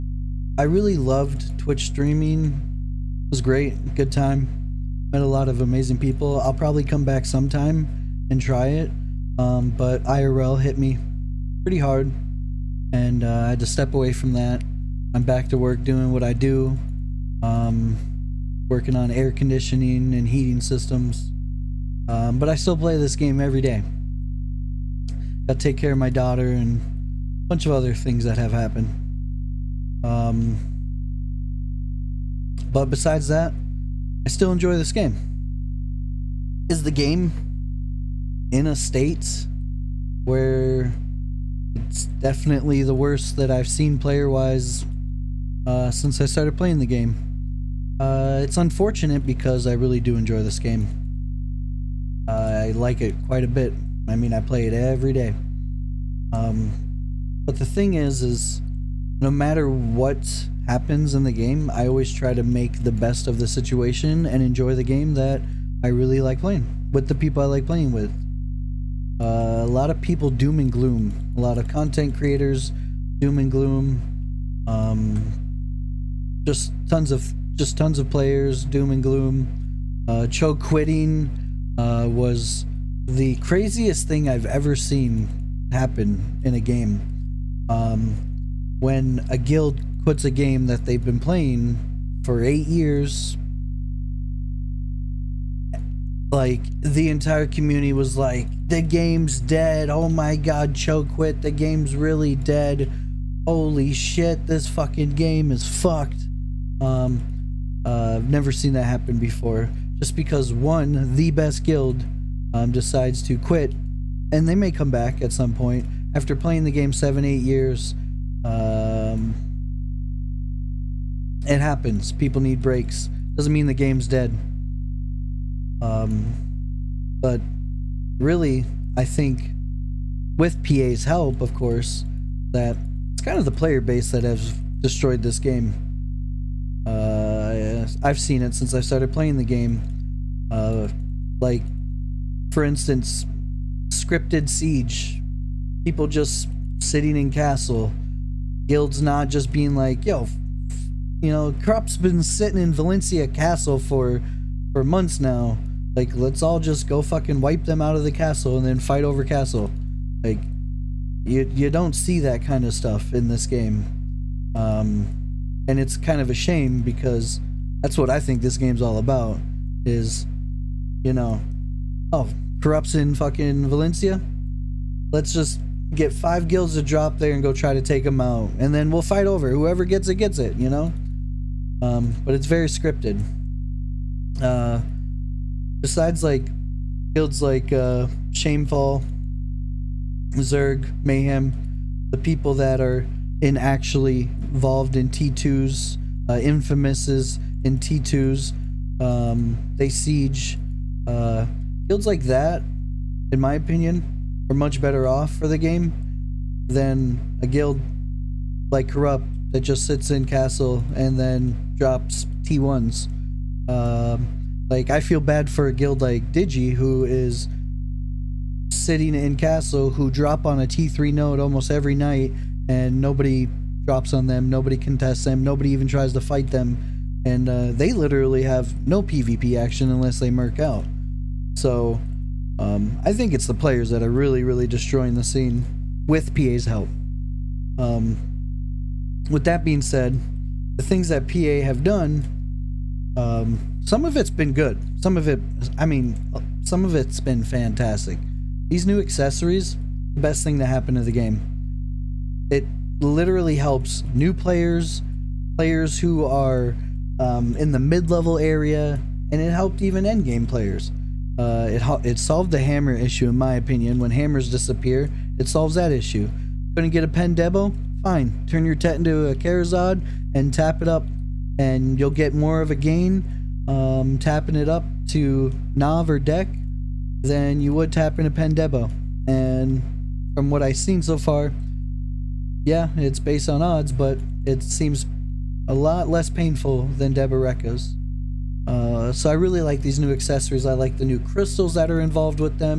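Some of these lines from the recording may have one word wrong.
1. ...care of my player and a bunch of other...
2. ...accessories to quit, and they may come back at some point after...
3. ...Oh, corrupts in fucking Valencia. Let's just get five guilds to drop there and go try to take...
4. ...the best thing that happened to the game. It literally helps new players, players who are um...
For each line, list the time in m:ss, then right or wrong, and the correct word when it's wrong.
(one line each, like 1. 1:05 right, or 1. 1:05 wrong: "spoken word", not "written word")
1. 0:25 wrong: "daughter", not "player"
2. 1:52 wrong: "decides", not "accessories"
3. 2:52 right
4. 4:10 right.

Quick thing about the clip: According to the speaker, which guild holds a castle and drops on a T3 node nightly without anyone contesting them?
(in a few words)
Digi.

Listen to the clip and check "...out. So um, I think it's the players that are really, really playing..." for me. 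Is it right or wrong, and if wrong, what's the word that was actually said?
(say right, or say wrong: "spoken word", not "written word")
wrong: "destroying", not "playing".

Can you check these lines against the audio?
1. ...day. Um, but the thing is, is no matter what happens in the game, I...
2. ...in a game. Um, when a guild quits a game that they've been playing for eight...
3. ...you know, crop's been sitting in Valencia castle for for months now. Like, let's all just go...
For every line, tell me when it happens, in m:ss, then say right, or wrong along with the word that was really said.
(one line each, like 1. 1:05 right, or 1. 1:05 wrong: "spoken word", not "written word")
1. 0:55 right
2. 1:26 right
3. 2:31 right.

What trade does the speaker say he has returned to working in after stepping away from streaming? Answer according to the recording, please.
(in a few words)
Air conditioning and heating systems.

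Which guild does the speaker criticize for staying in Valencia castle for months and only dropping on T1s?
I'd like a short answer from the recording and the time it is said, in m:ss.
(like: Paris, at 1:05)
Corrupt, at 3:28.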